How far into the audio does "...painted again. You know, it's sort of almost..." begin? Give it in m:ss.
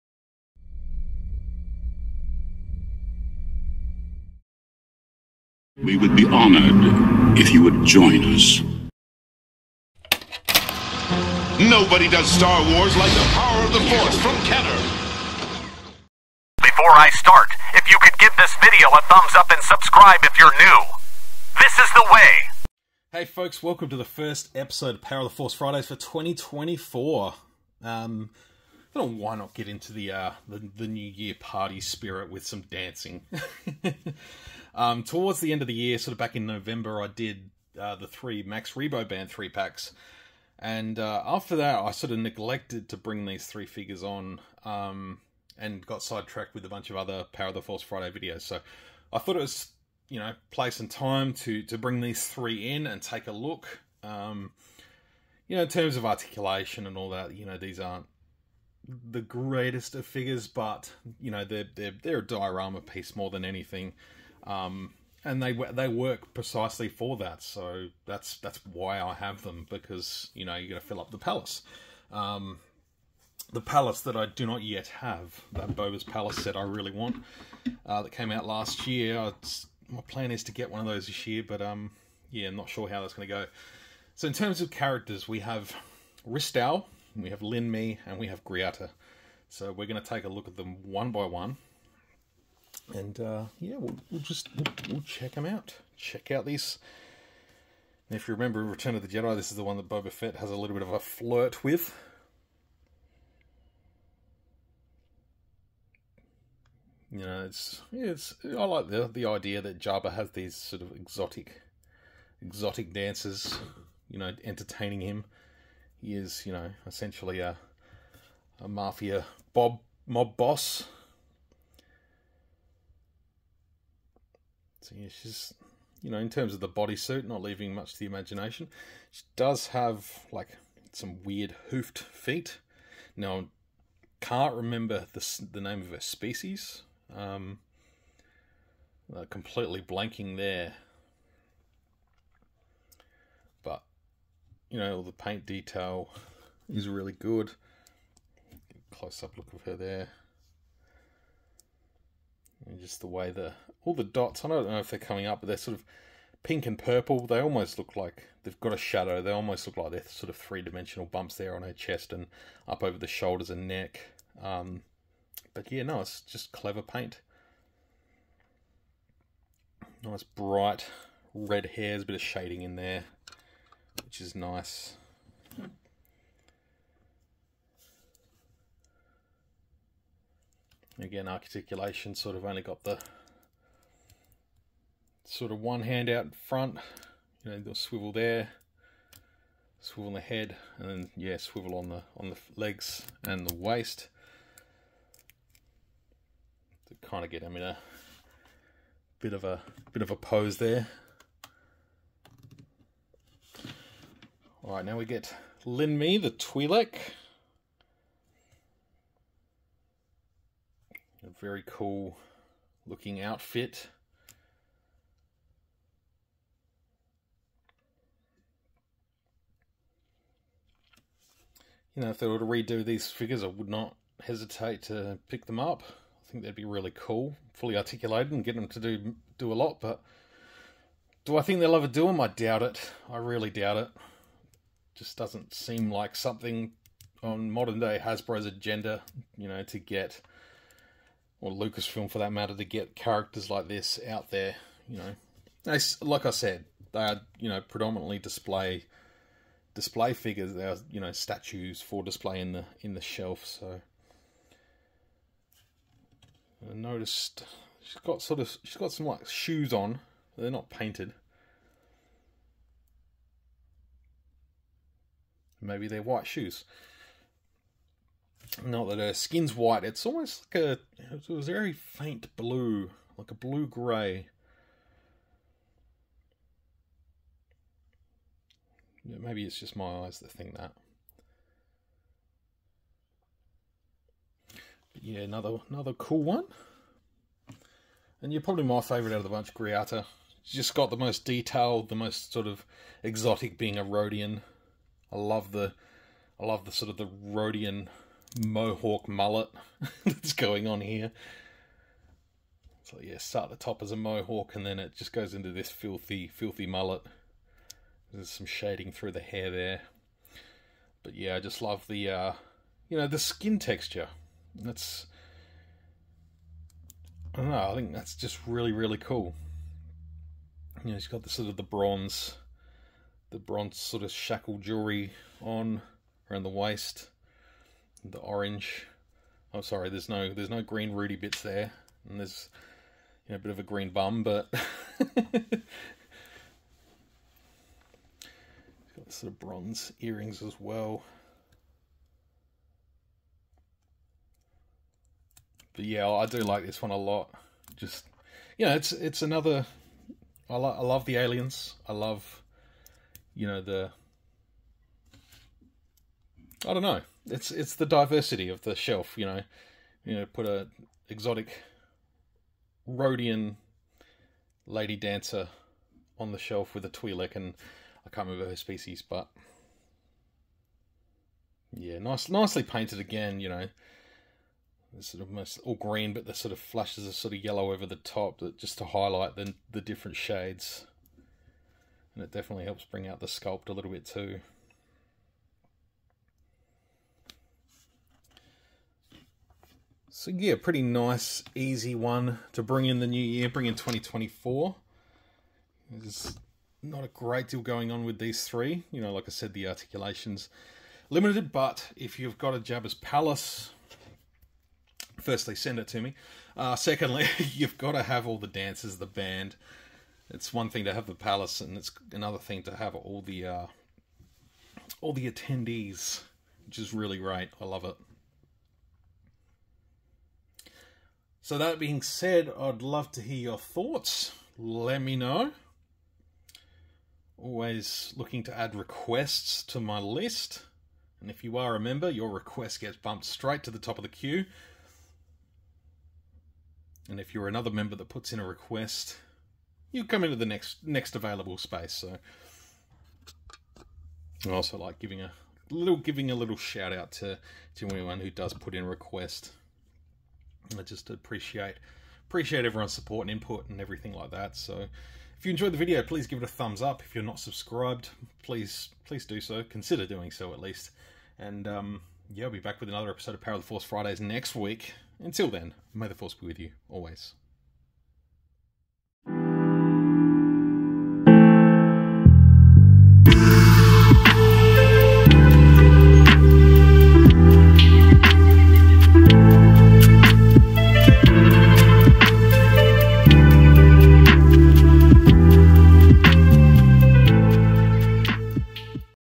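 6:12.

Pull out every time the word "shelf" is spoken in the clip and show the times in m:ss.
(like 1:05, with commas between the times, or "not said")
4:13, 5:58, 6:06.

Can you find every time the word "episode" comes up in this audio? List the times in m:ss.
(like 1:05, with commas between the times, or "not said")
0:24, 7:43.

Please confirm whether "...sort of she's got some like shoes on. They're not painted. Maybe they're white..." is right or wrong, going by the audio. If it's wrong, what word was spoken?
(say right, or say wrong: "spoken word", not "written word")
right.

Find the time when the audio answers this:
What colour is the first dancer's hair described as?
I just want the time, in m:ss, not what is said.
2:50.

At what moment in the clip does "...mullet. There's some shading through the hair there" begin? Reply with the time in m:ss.
5:06.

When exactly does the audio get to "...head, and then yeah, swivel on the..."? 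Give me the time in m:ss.
3:10.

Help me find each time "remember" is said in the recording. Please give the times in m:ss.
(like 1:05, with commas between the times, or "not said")
1:38, 2:14, 6:08.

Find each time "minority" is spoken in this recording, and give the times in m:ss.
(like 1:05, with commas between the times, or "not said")
not said.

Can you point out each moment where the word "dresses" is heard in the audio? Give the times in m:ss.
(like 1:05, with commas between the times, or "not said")
not said.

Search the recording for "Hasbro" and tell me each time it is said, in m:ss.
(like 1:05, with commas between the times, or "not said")
3:57.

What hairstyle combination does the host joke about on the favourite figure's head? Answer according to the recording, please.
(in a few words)
Mohawk mullet.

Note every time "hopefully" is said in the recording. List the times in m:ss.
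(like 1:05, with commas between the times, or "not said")
not said.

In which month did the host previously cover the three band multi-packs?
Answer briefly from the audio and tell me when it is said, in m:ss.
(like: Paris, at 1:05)
November, at 0:36.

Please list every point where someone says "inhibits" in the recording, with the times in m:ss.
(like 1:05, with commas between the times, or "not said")
not said.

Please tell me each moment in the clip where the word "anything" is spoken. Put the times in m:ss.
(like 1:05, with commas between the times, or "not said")
1:03.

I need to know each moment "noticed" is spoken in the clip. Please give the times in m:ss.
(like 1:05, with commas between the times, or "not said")
4:16.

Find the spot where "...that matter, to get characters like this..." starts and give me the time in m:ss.
4:02.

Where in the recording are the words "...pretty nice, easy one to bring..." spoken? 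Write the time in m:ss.
6:30.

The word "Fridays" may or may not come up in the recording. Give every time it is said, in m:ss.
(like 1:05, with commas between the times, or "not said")
0:25, 0:47, 7:43.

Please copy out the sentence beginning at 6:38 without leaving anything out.
You know, like I said, the articulation's limited, but if you've got a Jabba's Palace, firstly, send it to me.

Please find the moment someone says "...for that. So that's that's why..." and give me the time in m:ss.
1:06.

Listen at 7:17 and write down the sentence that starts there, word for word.
And if you're another member that puts in a request, you come into the next next available space.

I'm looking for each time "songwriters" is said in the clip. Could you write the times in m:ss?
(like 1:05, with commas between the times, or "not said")
not said.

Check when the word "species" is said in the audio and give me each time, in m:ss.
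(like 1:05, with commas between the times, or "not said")
2:15, 6:08.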